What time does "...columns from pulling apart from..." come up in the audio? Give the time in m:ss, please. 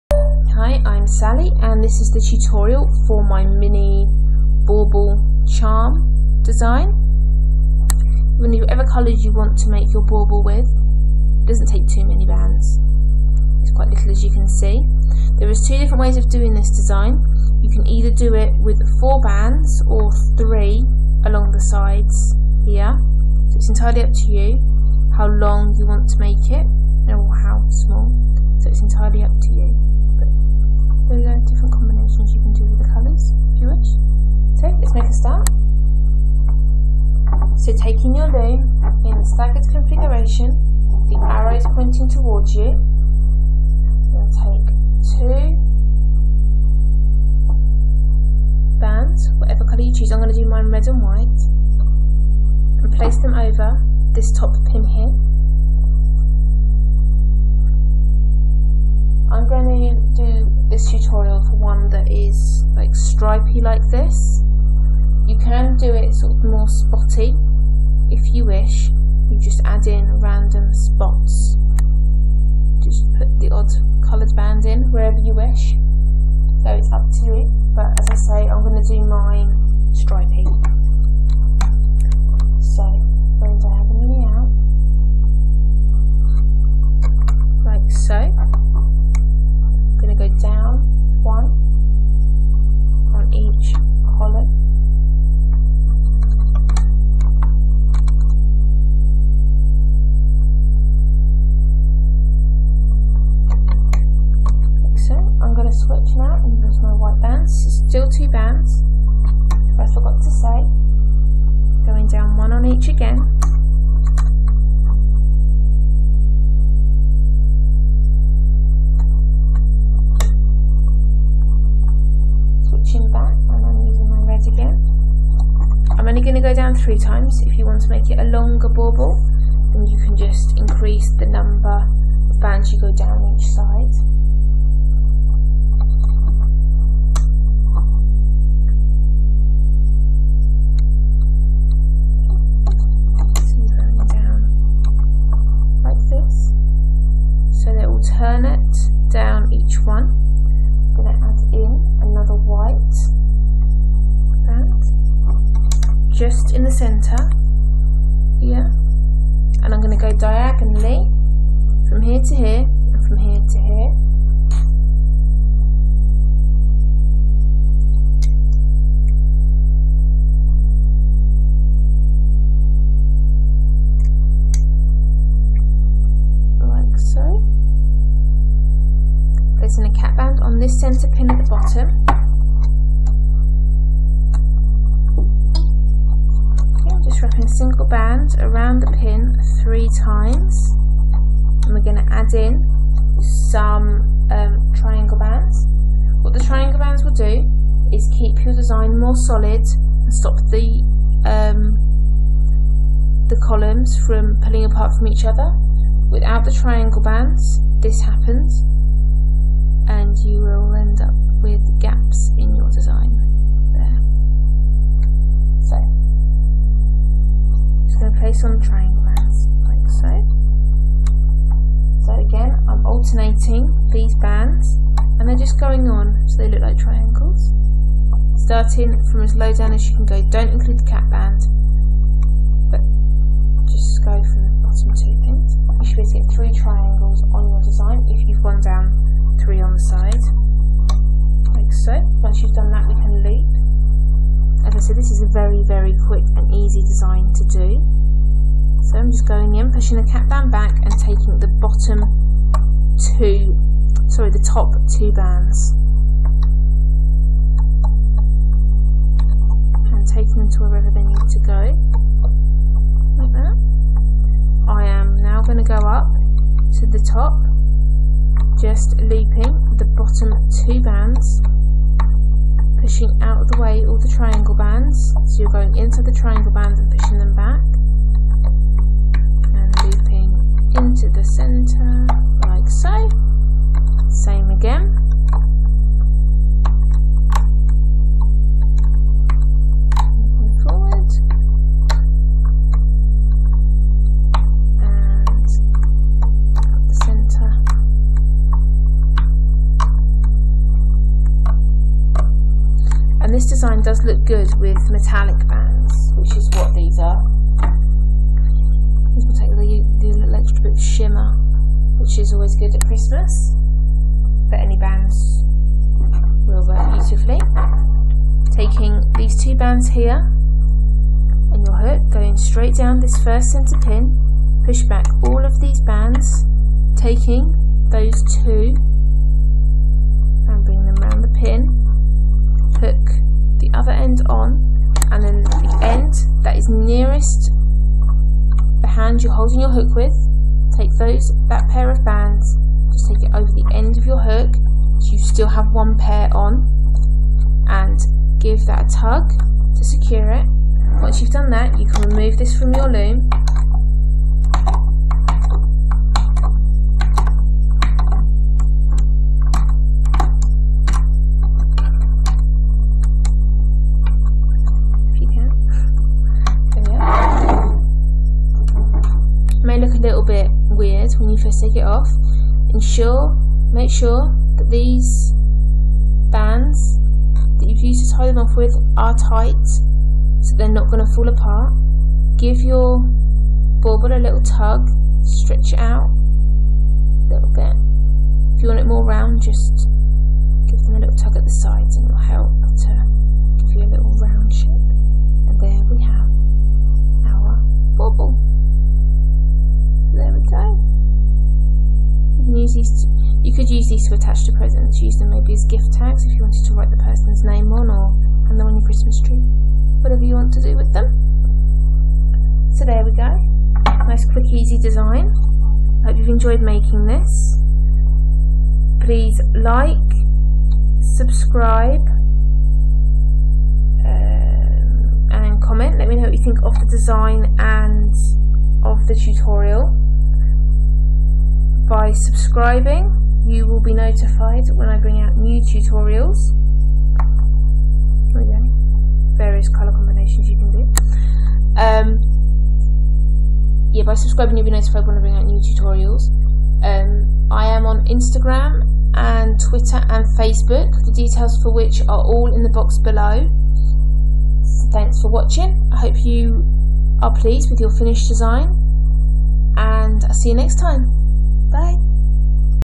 3:23.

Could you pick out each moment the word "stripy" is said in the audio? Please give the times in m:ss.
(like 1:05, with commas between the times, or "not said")
1:02, 1:19.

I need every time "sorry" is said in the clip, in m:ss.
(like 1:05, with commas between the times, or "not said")
4:14.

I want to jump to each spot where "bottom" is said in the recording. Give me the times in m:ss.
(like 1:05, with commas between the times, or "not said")
3:01, 4:11, 4:29.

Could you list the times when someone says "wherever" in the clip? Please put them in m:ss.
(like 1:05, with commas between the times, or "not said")
1:14, 4:20.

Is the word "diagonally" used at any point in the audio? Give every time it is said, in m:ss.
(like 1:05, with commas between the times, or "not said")
2:40.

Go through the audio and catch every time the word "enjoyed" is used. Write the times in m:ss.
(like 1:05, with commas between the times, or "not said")
6:56.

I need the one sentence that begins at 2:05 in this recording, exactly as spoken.
I'm only going to go down three times.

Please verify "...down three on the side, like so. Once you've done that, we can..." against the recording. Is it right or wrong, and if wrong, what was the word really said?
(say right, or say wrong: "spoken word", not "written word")
right.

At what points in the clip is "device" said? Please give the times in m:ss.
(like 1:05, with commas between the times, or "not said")
not said.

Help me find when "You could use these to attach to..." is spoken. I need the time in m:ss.
6:43.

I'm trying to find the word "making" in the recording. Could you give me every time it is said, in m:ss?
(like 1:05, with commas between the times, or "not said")
6:56.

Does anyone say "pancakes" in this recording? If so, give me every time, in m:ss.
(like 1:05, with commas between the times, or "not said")
not said.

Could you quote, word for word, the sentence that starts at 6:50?
Whatever you want to do with them.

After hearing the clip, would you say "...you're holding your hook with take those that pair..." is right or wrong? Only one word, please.
right.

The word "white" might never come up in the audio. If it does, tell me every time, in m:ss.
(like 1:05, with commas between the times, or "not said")
0:51, 1:46, 2:32.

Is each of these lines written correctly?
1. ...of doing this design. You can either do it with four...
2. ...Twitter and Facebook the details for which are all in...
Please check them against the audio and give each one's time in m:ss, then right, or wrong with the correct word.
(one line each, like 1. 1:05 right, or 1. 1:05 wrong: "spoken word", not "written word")
1. 0:16 right
2. 7:29 right.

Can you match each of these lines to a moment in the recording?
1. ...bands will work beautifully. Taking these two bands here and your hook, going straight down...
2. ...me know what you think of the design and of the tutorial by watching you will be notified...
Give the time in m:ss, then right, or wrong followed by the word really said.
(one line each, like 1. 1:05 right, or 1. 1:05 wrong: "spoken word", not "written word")
1. 5:14 right
2. 7:06 wrong: "subscribing", not "watching".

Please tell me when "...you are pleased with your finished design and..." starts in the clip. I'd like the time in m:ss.
7:36.